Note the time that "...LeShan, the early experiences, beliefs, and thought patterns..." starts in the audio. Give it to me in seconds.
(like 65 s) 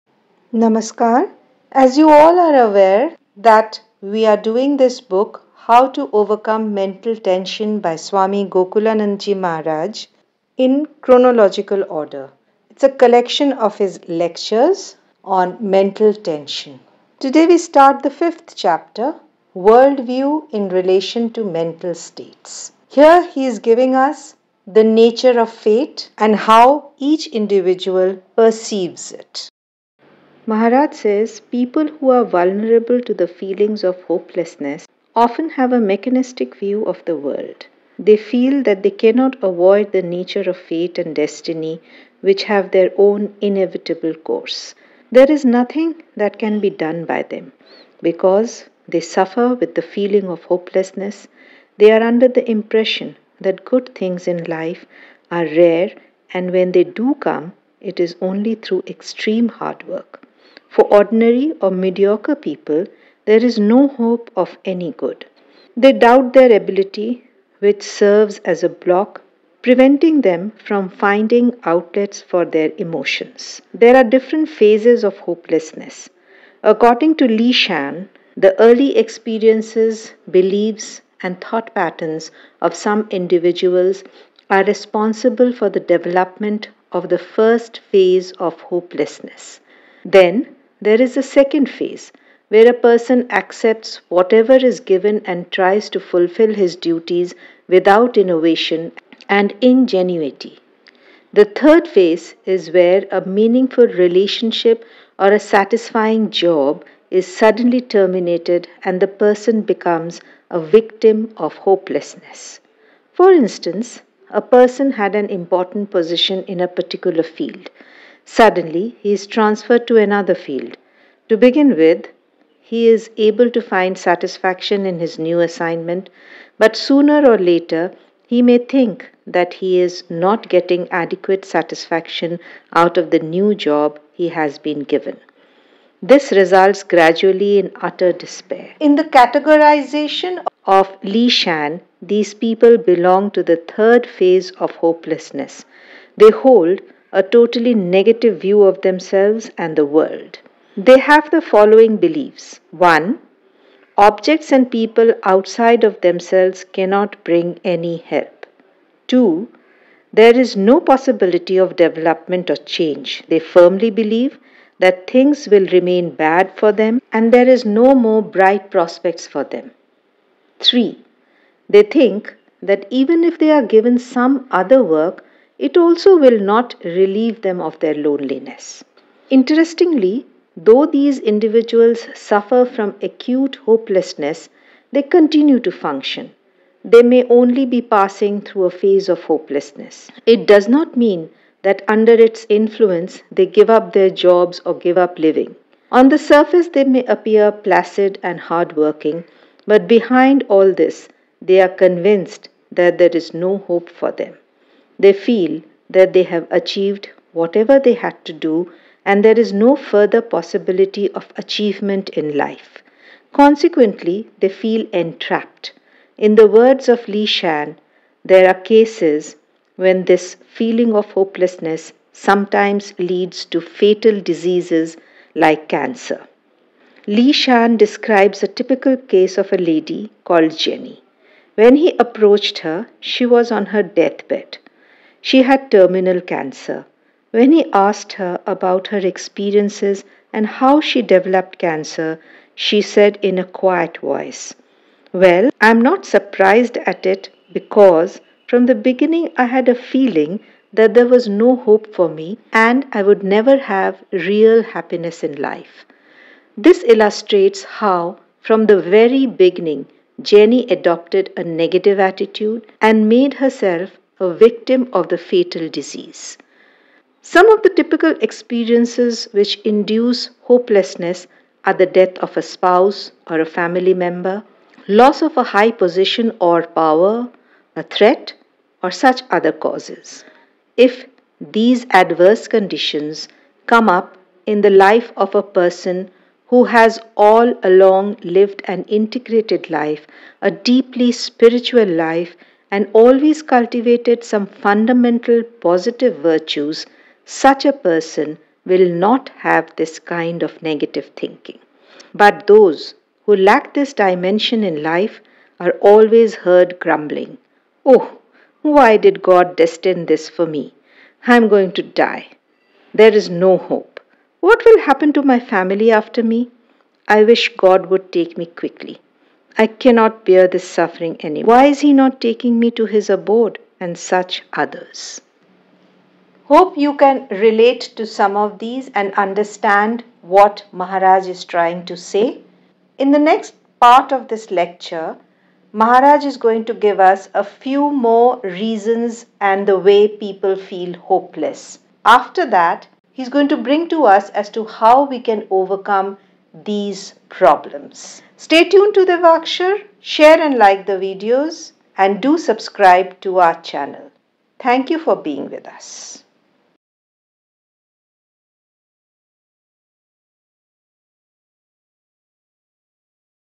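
77 s.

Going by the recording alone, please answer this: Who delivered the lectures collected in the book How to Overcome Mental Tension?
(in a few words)
Swami Gokulanandji Maharaj.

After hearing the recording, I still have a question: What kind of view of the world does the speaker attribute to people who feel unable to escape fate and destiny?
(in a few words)
Mechanistic.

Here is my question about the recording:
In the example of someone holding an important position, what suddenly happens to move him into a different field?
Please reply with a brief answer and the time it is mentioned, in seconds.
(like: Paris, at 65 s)
He is transferred, at 119 s.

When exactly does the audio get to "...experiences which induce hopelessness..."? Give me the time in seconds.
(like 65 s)
268 s.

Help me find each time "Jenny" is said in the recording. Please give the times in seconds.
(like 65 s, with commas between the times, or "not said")
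230 s, 260 s.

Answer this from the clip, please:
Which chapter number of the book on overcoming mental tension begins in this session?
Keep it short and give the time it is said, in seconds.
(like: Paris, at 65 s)
5th, at 18 s.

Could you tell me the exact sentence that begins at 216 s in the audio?
In the words of LeShan, there are cases when this feeling of hopelessness sometimes leads to fatal diseases like cancer.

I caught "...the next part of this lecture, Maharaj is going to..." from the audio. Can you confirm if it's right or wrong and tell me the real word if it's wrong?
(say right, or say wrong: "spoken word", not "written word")
right.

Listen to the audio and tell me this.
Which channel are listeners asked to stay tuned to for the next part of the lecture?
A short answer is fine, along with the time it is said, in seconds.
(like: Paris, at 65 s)
Devakshar, at 349 s.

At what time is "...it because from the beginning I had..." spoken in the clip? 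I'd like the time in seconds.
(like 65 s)
247 s.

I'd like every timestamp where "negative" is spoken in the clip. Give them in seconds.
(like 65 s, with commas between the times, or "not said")
147 s, 261 s, 300 s.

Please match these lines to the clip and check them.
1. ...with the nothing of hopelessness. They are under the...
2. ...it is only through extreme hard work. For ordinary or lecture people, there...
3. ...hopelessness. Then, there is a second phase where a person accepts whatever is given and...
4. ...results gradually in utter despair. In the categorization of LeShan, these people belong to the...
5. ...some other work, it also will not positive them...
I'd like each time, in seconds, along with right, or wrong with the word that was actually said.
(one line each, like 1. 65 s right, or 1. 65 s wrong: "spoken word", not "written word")
1. 49 s wrong: "feeling", not "nothing"
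2. 57 s wrong: "mediocre", not "lecture"
3. 88 s right
4. 136 s right
5. 173 s wrong: "relieve", not "positive".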